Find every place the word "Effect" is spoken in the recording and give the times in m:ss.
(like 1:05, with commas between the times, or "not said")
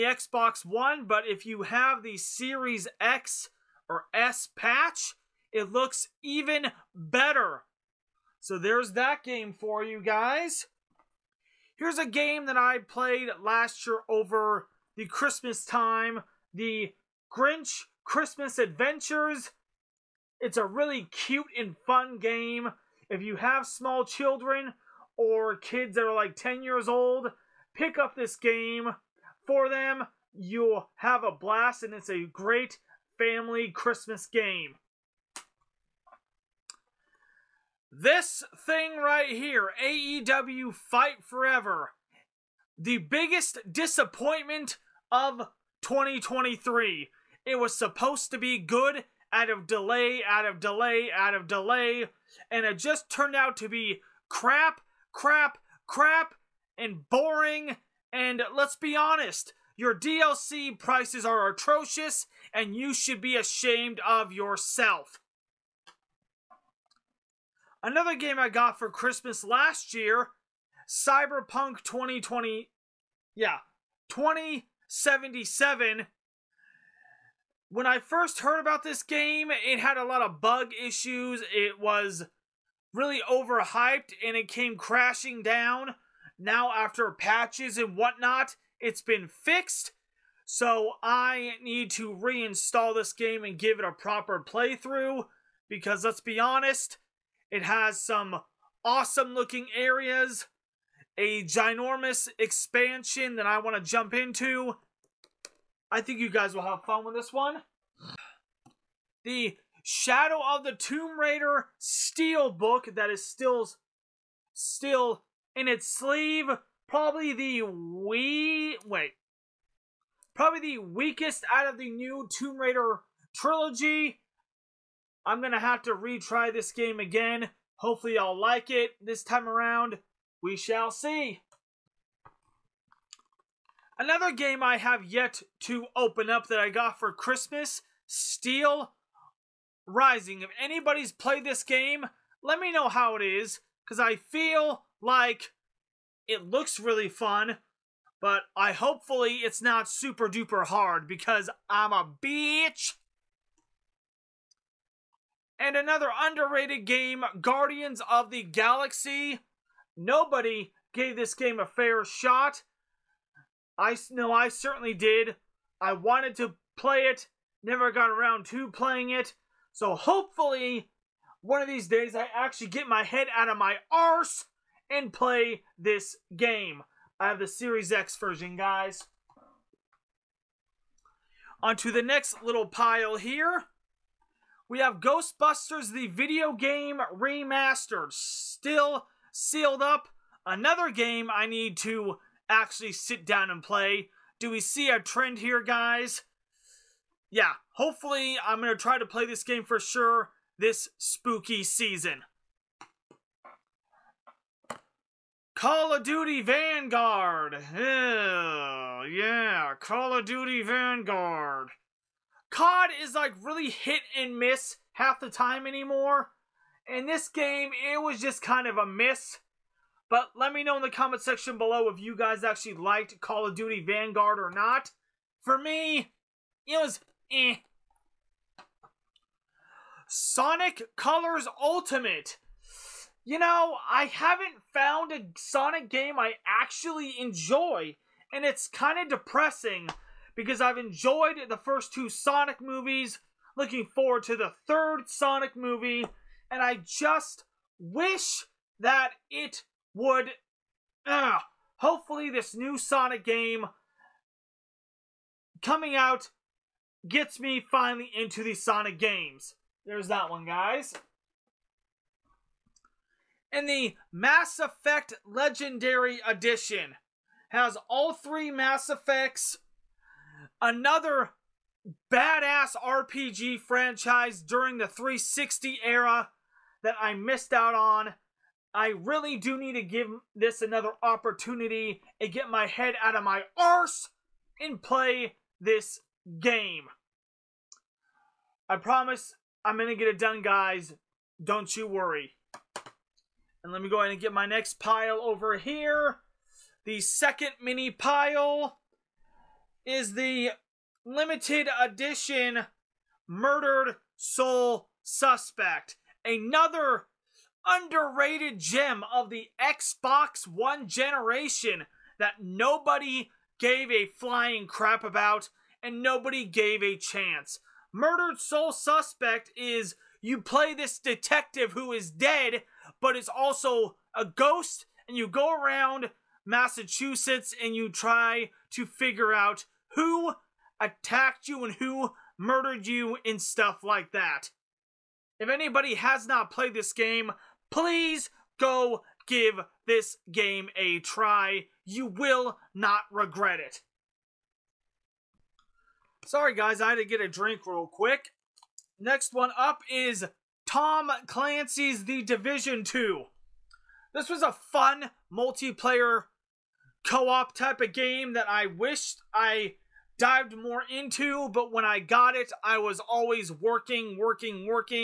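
4:24, 4:28.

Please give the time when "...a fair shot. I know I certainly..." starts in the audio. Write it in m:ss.
2:41.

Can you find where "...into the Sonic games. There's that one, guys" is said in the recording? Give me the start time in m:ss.
4:18.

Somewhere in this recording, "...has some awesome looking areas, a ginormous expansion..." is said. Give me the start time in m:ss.
1:37.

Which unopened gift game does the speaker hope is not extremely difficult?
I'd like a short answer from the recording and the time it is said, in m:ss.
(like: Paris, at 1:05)
Steel Rising, at 2:18.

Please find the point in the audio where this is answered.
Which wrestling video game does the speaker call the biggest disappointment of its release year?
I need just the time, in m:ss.
0:39.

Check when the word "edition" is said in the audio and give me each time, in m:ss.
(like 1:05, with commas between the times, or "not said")
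4:26, 5:01.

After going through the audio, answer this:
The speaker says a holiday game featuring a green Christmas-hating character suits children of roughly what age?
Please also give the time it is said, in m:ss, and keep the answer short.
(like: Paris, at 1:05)
10, at 0:26.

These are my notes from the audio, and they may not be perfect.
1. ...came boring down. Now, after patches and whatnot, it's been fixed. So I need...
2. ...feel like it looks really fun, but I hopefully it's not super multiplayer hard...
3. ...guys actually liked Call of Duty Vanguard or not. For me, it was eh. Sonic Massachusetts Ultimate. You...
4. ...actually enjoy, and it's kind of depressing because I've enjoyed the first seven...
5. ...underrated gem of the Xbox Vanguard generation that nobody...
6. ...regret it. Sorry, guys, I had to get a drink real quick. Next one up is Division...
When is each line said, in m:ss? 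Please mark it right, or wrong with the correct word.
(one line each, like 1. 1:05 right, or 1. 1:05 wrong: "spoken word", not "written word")
1. 1:24 wrong: "crashing", not "boring"
2. 2:24 wrong: "duper", not "multiplayer"
3. 3:42 wrong: "Colors", not "Massachusetts"
4. 3:56 wrong: "two", not "seven"
5. 5:07 wrong: "One", not "Vanguard"
6. 5:43 wrong: "Tom", not "Division".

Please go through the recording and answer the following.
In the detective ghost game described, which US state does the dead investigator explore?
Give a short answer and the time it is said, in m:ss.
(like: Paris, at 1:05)
Massachusetts, at 5:26.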